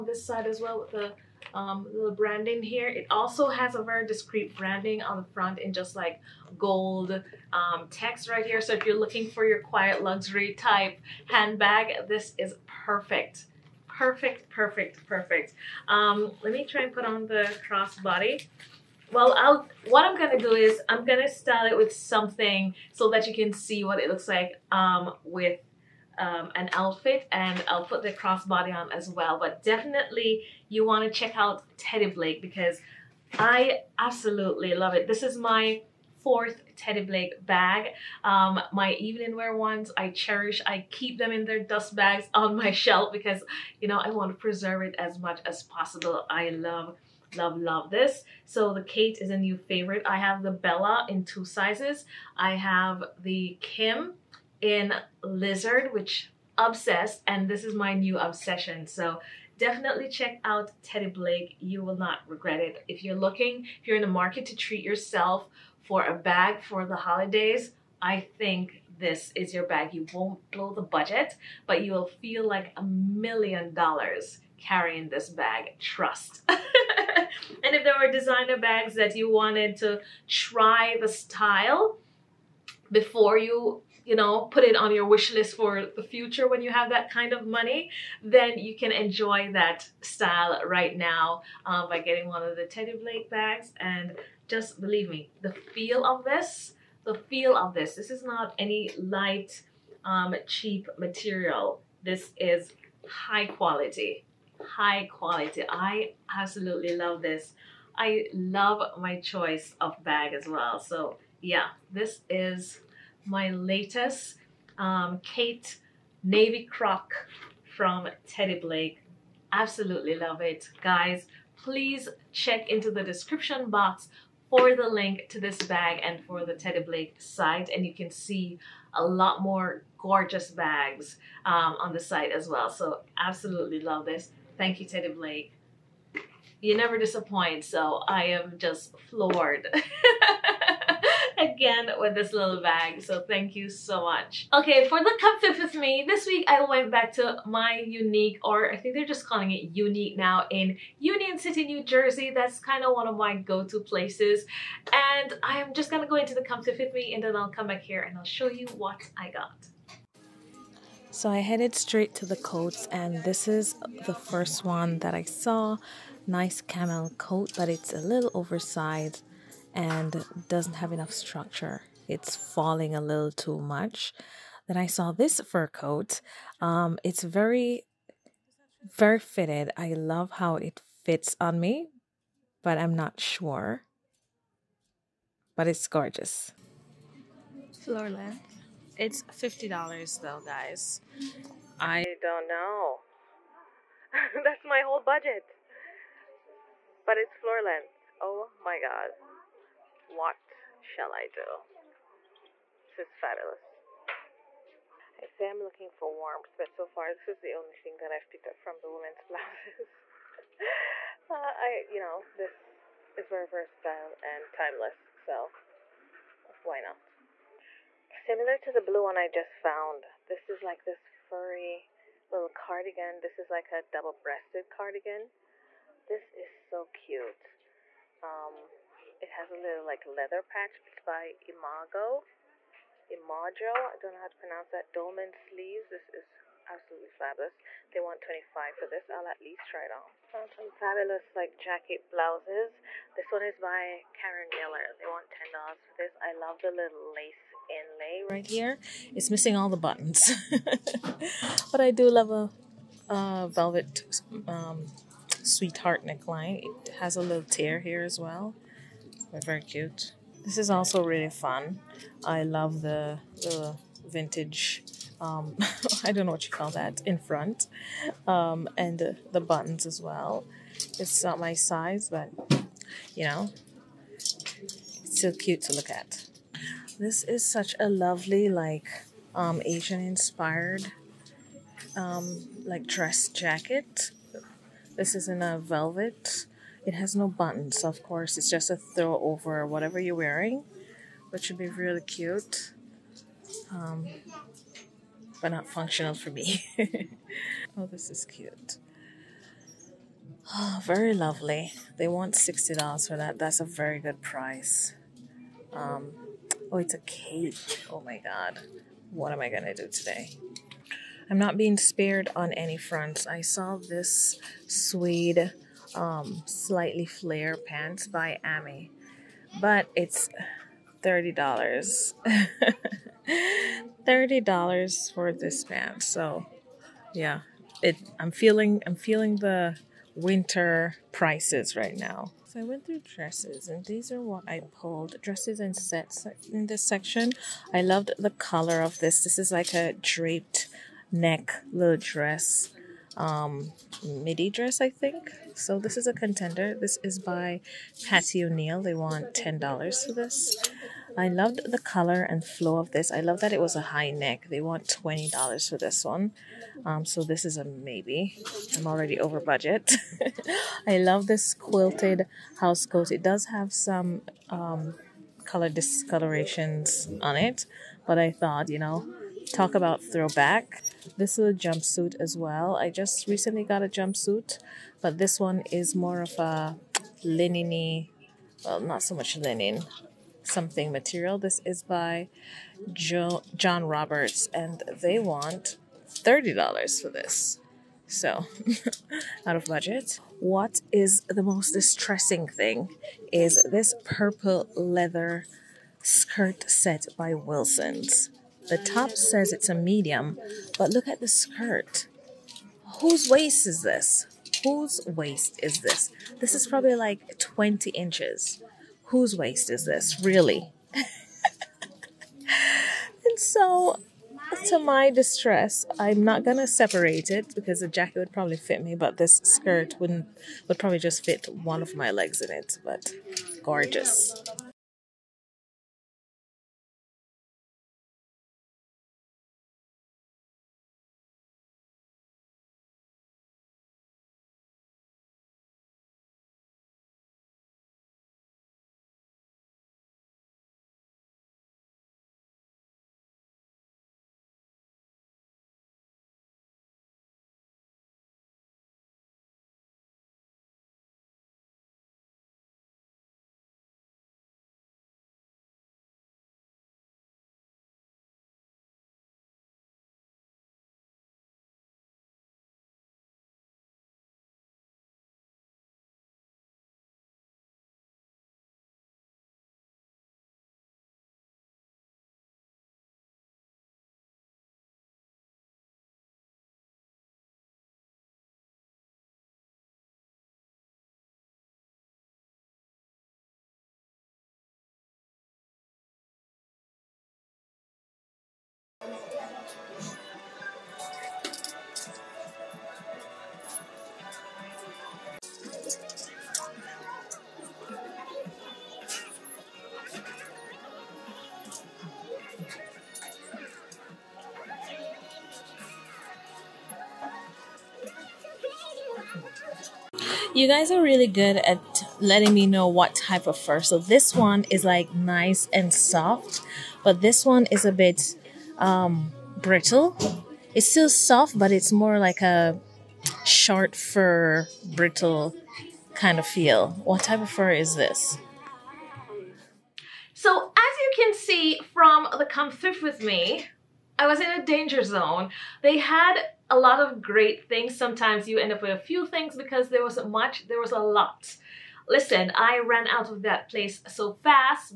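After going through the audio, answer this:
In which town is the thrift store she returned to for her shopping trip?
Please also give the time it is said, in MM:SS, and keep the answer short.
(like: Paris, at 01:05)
Union City, at 02:30.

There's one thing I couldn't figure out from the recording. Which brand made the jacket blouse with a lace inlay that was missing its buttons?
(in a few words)
Karen Millen.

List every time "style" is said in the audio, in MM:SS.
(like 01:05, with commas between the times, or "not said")
00:21, 01:21, 01:30.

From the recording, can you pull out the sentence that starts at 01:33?
And just believe me, the feel of this, the feel of this, this is not any light, um, cheap material.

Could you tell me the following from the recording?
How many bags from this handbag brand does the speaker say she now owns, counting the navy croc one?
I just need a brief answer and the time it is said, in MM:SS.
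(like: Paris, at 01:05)
4, at 00:36.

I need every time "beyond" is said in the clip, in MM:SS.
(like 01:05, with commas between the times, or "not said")
not said.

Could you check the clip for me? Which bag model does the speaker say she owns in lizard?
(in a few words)
Kim.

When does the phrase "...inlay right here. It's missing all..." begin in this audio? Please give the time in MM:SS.
04:07.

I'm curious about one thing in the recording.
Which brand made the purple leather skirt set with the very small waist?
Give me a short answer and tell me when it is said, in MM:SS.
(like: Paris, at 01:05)
Wilson's, at 06:37.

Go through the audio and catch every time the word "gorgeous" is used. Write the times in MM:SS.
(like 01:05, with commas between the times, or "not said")
02:09, 03:05, 07:03.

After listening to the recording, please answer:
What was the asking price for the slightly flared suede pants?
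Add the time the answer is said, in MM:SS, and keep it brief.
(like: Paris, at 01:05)
$30, at 05:24.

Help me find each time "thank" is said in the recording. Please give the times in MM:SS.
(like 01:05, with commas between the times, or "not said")
02:14, 02:23.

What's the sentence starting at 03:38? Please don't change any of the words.
Similar to the blue one I just found.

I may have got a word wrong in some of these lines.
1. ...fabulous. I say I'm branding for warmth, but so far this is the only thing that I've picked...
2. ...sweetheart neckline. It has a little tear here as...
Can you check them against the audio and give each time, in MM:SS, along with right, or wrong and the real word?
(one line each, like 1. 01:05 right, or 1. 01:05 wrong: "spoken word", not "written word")
1. 03:23 wrong: "looking", not "branding"
2. 04:15 right.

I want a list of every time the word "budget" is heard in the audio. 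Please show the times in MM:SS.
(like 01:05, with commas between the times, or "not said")
01:10, 03:15, 05:59, 06:29.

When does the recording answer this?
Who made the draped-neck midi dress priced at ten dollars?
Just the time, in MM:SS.
05:48.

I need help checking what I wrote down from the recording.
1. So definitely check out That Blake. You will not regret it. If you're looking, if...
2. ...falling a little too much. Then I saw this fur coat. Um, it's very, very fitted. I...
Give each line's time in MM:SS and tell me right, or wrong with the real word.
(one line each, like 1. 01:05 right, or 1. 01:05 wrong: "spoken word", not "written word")
1. 00:58 wrong: "Teddy", not "That"
2. 02:52 right.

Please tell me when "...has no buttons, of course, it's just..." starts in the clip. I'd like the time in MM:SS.
04:46.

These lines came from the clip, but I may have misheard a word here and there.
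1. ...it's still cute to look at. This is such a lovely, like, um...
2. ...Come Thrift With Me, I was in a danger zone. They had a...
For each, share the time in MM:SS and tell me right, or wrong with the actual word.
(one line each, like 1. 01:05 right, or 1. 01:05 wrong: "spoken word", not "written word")
1. 04:34 right
2. 08:52 right.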